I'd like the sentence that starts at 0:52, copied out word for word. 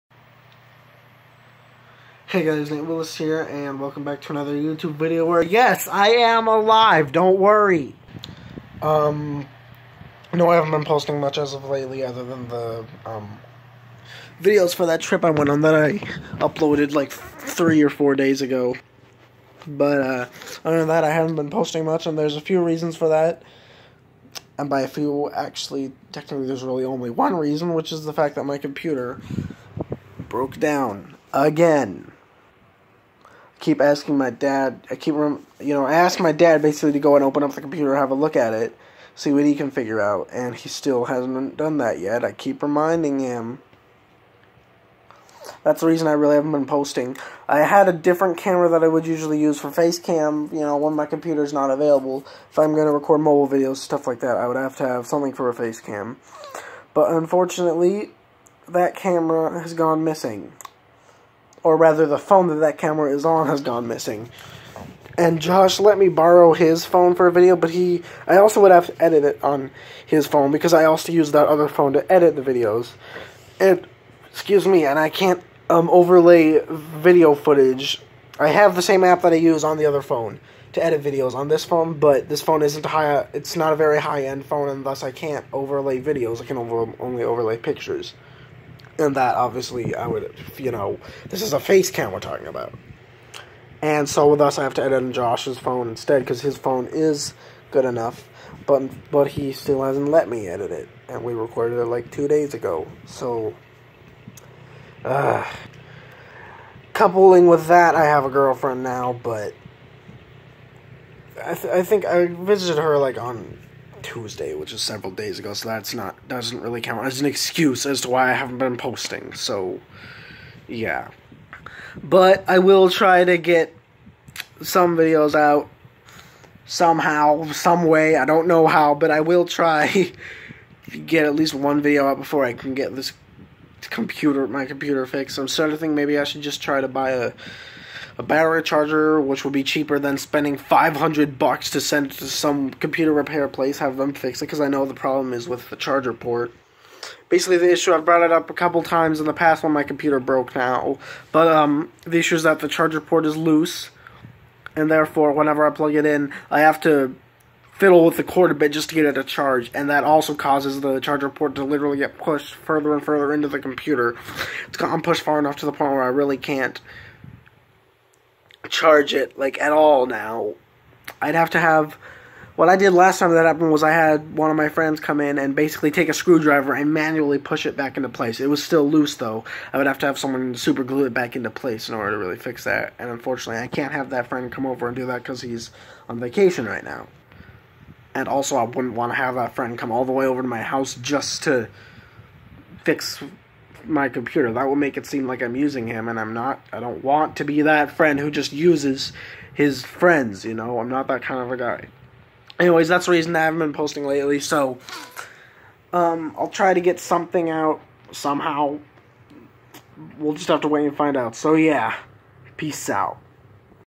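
If I'm going to record mobile videos, stuff like that, I would have to have something for a face cam.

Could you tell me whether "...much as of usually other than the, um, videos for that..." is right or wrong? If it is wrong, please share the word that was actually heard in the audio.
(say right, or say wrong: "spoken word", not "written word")
wrong: "lately", not "usually".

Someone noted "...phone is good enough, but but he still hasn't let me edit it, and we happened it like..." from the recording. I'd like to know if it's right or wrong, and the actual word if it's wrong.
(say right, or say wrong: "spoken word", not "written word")
wrong: "recorded", not "happened".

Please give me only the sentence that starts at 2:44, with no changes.
It's gotten pushed far enough to the point where I really can't charge it like at all now.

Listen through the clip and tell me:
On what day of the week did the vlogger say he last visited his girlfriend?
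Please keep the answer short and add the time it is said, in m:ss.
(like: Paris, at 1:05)
Tuesday, at 1:54.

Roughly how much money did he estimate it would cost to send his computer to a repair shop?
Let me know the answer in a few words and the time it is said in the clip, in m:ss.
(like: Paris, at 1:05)
$500, at 2:20.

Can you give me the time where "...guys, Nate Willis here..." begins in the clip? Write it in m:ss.
0:02.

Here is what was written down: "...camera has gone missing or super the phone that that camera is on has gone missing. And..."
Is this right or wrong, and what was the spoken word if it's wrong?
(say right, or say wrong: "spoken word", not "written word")
wrong: "rather", not "super".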